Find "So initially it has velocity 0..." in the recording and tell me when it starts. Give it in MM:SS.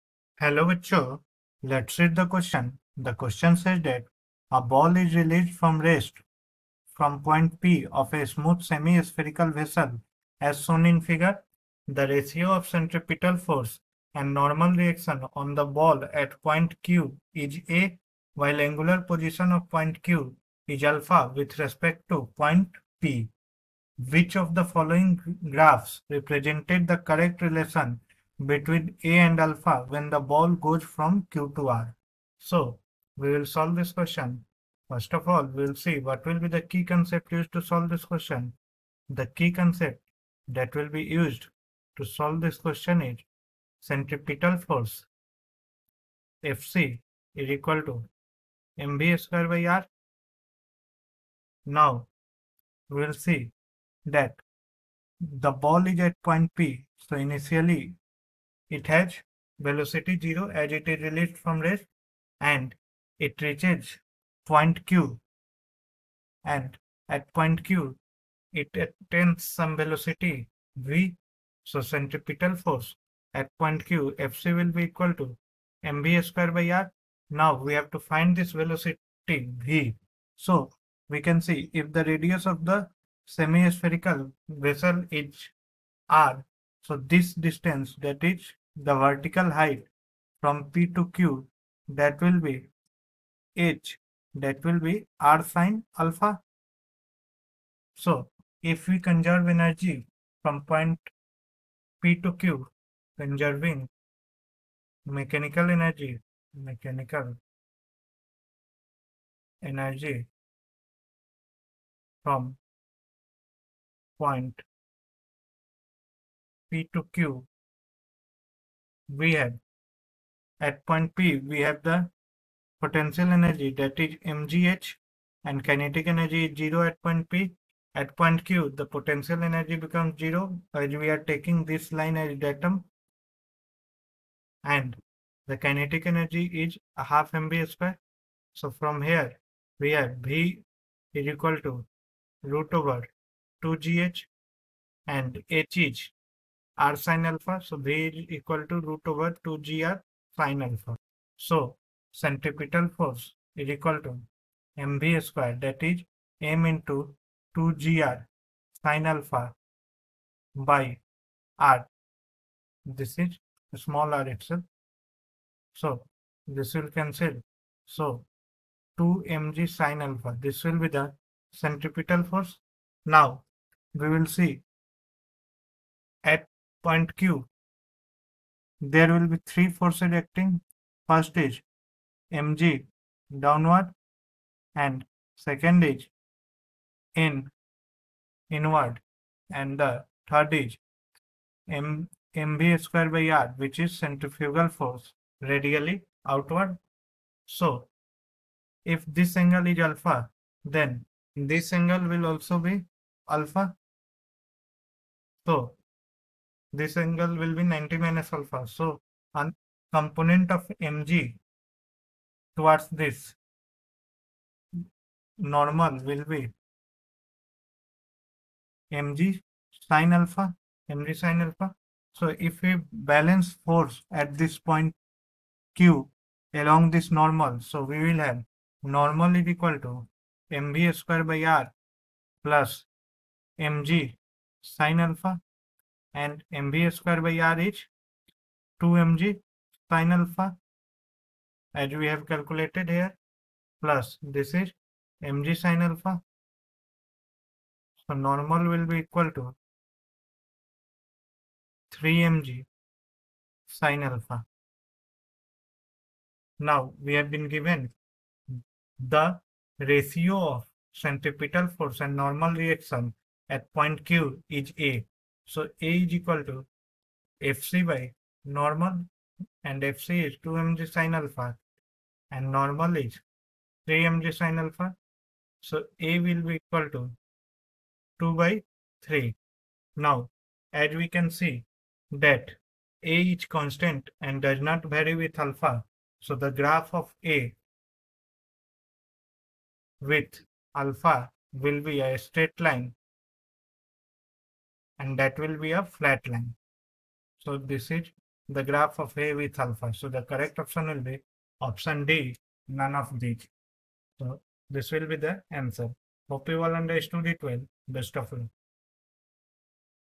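00:56.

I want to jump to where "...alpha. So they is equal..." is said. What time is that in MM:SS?
02:27.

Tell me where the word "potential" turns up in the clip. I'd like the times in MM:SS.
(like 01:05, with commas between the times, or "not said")
02:02, 02:08.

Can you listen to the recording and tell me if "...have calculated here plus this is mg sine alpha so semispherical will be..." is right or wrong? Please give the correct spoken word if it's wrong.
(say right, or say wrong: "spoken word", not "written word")
wrong: "normal", not "semispherical".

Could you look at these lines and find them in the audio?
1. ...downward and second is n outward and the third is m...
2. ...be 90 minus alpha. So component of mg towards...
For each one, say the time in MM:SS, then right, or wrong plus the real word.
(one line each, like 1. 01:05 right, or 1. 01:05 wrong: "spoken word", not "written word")
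1. 03:03 wrong: "inward", not "outward"
2. 03:27 right.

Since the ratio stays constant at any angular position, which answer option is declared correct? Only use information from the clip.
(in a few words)
Option D.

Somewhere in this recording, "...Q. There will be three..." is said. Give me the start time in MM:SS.
02:57.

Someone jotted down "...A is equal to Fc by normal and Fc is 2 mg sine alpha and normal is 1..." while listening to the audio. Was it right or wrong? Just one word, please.
wrong.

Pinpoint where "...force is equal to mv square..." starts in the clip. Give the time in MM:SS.
02:32.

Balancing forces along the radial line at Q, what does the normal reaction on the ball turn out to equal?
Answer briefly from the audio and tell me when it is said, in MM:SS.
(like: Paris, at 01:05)
3mg sine alpha, at 04:11.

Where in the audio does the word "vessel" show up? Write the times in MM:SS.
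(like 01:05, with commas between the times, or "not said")
00:09, 01:24.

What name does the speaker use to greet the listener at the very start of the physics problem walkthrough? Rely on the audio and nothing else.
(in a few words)
Vichu.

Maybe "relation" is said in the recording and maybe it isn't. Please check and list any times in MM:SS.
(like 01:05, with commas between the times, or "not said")
00:27.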